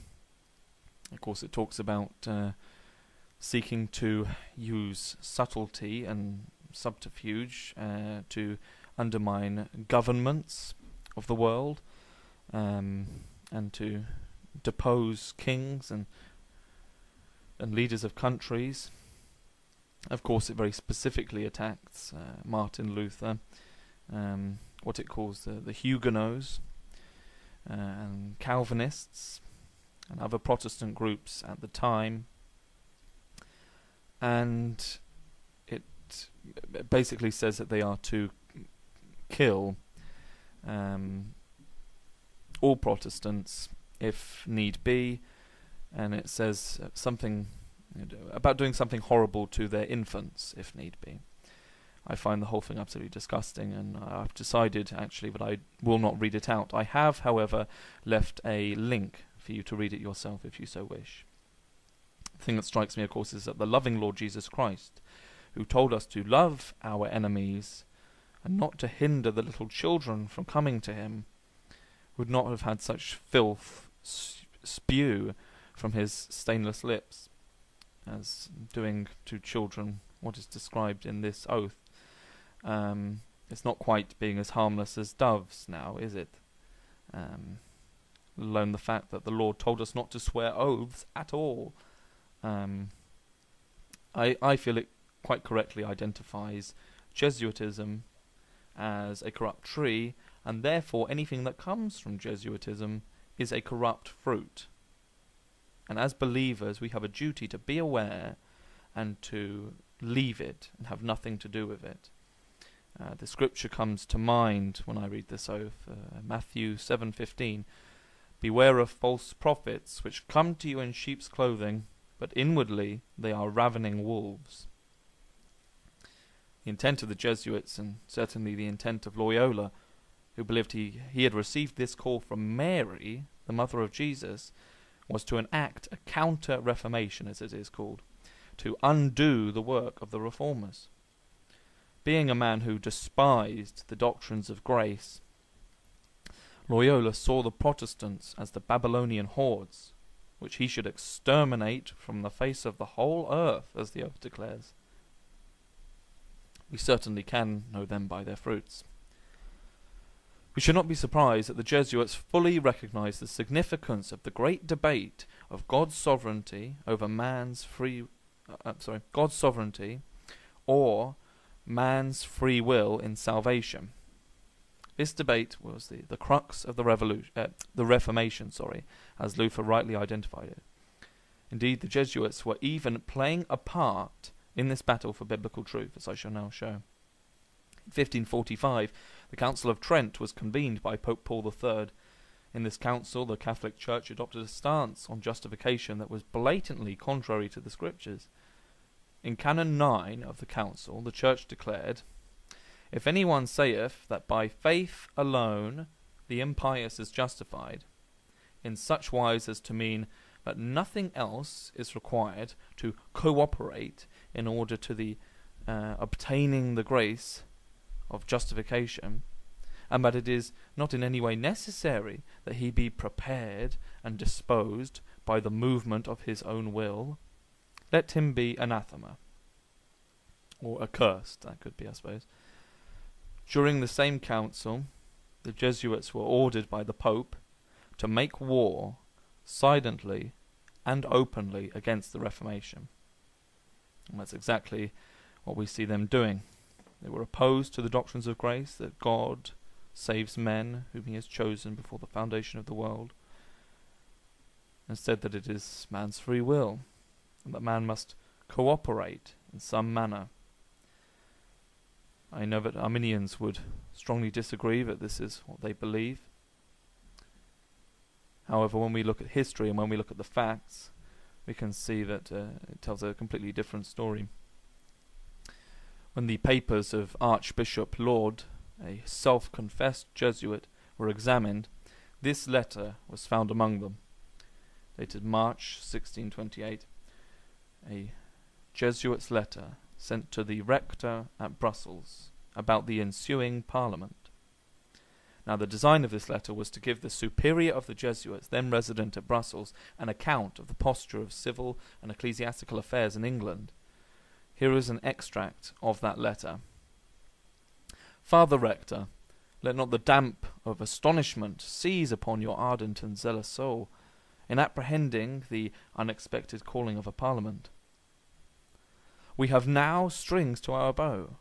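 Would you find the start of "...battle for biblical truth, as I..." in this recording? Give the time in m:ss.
3:04.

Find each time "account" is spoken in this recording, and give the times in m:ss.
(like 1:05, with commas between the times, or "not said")
5:00.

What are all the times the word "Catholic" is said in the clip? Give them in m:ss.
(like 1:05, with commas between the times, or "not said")
3:13.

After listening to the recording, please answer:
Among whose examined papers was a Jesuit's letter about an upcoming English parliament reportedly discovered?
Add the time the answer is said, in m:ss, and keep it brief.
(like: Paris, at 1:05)
Archbishop Laud, at 4:37.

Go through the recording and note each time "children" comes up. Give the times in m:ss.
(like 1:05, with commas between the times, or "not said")
1:09, 1:19.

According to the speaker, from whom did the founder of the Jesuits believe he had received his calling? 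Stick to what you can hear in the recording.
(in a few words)
Mary, the mother of Jesus.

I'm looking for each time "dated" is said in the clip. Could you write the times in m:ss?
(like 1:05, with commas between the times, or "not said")
4:44.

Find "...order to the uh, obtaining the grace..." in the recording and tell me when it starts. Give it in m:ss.
3:34.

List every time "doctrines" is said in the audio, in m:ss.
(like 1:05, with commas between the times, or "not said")
2:23, 4:07.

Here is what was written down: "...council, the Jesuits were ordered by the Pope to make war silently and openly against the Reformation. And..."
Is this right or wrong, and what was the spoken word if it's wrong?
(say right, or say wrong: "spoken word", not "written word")
right.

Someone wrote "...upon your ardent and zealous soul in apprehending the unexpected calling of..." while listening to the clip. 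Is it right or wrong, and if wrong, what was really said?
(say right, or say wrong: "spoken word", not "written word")
right.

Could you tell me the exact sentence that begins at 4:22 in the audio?
I know that Arminians would strongly disagree that this is what they believe.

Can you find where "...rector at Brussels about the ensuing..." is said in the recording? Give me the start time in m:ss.
4:50.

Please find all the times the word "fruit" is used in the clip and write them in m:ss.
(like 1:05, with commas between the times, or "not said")
1:44, 2:38.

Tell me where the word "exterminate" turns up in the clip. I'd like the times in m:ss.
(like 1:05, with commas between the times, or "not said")
2:30.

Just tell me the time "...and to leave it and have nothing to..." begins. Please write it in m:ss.
1:48.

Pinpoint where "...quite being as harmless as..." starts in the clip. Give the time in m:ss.
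1:23.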